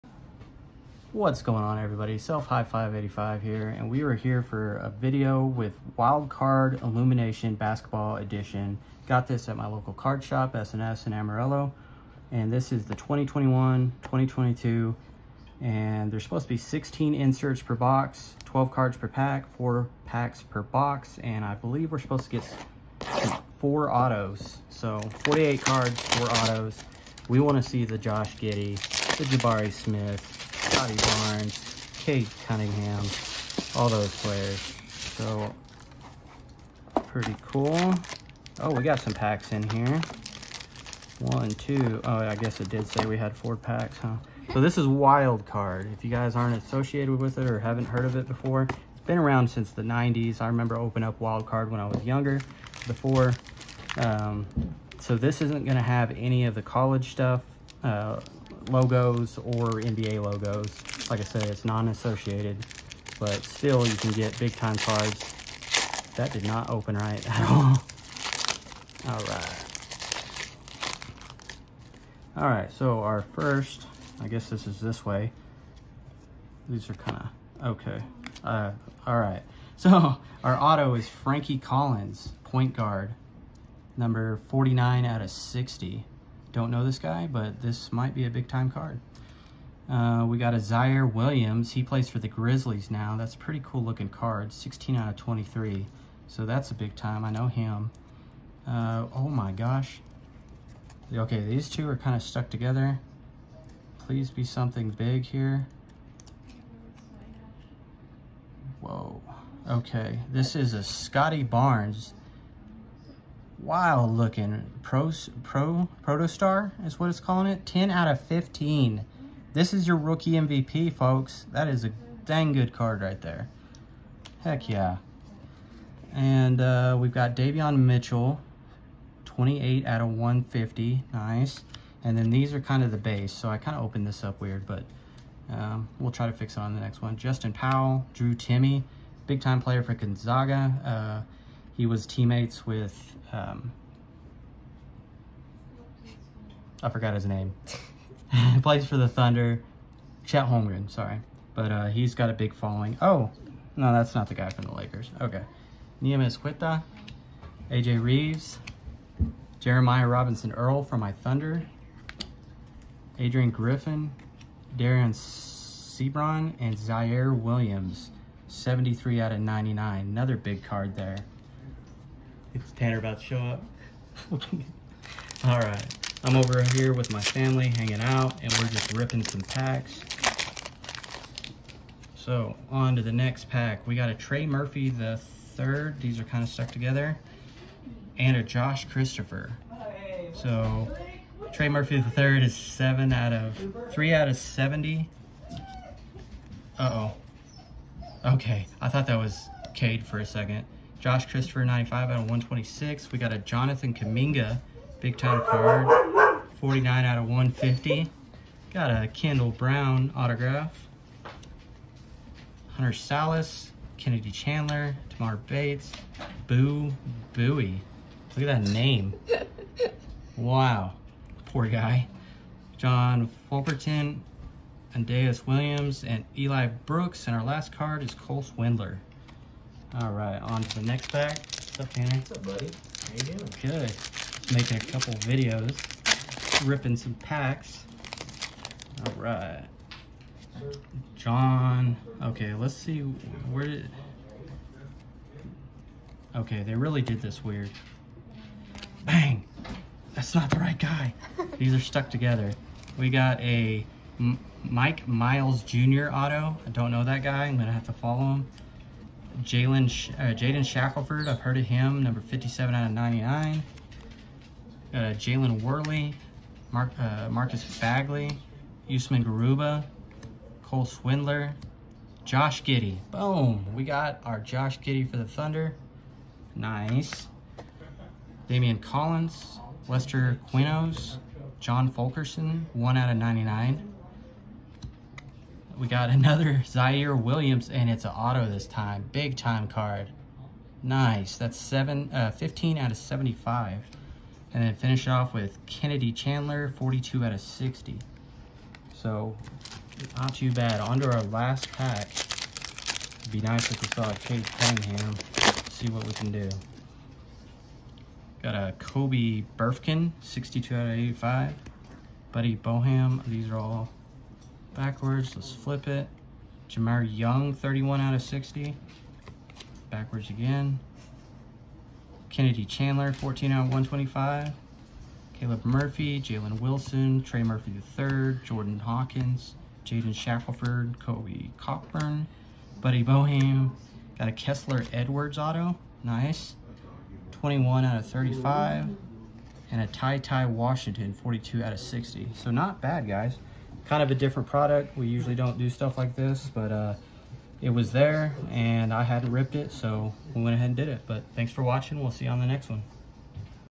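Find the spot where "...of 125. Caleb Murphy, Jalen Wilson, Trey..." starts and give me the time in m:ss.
5:23.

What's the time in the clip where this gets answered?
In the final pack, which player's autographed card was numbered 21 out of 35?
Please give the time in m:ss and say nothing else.
5:34.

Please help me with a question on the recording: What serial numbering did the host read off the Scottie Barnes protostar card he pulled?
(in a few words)
10 out of 15.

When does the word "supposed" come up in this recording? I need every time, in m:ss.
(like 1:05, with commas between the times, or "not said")
0:16, 0:21.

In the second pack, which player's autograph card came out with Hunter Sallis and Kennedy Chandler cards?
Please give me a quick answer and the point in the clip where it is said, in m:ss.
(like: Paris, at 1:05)
Kendall Brown, at 3:29.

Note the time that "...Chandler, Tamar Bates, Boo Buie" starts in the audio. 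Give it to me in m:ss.
3:34.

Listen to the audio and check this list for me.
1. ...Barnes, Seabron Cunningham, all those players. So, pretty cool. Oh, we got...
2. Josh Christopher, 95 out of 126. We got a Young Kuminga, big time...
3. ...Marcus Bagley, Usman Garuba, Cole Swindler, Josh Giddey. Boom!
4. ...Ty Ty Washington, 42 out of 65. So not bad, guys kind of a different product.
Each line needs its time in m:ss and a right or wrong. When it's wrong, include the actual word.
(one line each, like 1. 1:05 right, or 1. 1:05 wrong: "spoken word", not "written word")
1. 0:31 wrong: "Cade", not "Seabron"
2. 3:21 wrong: "Jonathan", not "Young"
3. 4:27 right
4. 5:39 wrong: "60", not "65".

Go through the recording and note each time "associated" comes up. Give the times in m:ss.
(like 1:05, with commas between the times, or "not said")
0:46, 1:01.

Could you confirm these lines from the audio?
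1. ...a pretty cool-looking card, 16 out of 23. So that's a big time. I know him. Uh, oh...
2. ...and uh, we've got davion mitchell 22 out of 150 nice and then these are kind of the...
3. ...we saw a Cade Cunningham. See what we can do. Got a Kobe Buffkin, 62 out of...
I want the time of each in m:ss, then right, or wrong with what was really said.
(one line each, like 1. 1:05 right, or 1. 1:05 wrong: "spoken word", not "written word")
1. 1:33 right
2. 2:06 wrong: "28", not "22"
3. 5:03 right.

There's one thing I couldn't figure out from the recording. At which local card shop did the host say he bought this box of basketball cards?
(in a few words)
SNS.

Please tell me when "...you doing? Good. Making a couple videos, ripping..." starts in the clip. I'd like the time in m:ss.
3:53.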